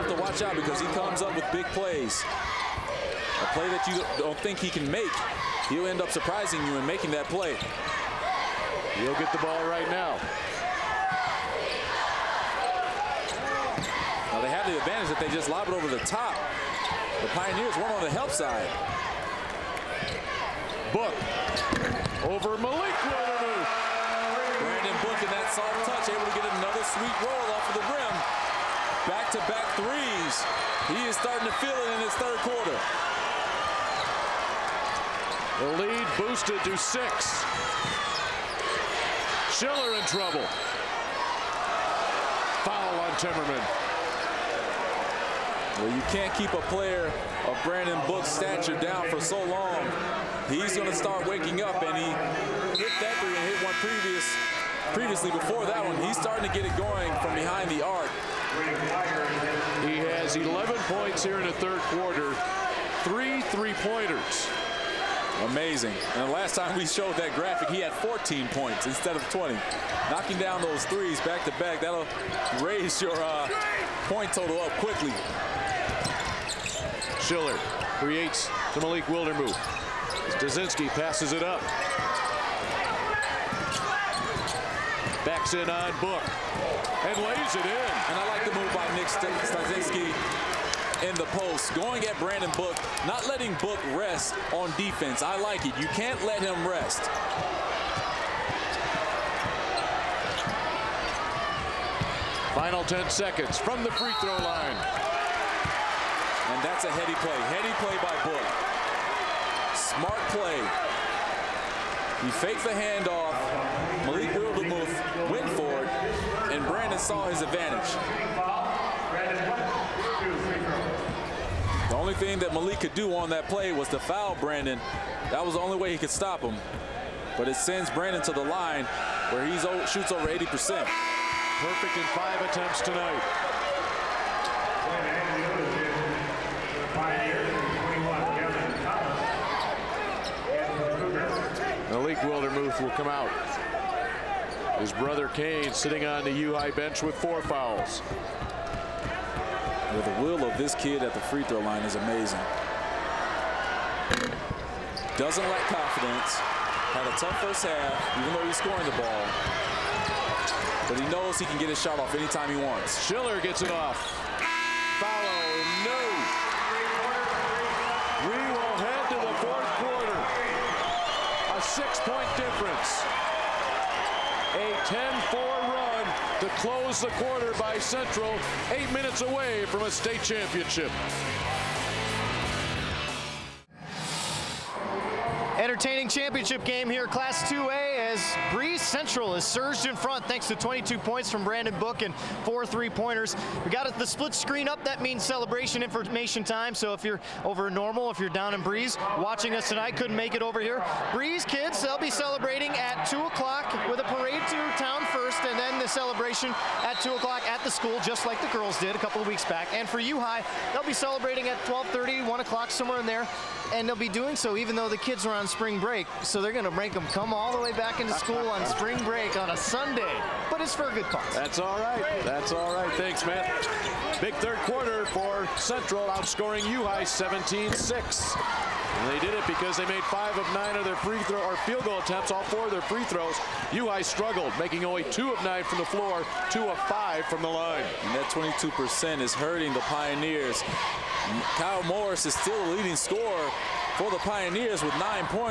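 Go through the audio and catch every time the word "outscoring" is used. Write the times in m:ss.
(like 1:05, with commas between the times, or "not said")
3:46.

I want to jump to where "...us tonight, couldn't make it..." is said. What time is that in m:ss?
3:19.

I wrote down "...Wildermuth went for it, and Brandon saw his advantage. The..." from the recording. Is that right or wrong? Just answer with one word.
right.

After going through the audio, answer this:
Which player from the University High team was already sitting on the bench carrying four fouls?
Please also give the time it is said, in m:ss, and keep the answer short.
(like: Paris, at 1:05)
Kane, at 2:25.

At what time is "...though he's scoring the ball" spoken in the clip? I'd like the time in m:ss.
2:38.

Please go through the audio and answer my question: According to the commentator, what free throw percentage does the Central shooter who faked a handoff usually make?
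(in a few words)
over 80%.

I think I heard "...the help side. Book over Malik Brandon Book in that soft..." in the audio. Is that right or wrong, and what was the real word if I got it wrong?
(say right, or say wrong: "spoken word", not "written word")
right.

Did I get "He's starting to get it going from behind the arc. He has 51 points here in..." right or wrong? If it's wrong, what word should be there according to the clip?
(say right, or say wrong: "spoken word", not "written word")
wrong: "11", not "51".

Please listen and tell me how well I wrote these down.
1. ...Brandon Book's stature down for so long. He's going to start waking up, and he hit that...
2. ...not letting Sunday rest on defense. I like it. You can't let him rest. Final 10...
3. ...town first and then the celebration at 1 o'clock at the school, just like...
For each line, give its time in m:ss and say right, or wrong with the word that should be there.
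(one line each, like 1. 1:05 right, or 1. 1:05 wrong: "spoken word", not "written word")
1. 0:47 right
2. 1:33 wrong: "Book", not "Sunday"
3. 3:24 wrong: "2", not "1".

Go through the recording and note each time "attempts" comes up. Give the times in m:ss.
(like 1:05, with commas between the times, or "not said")
2:12, 3:51.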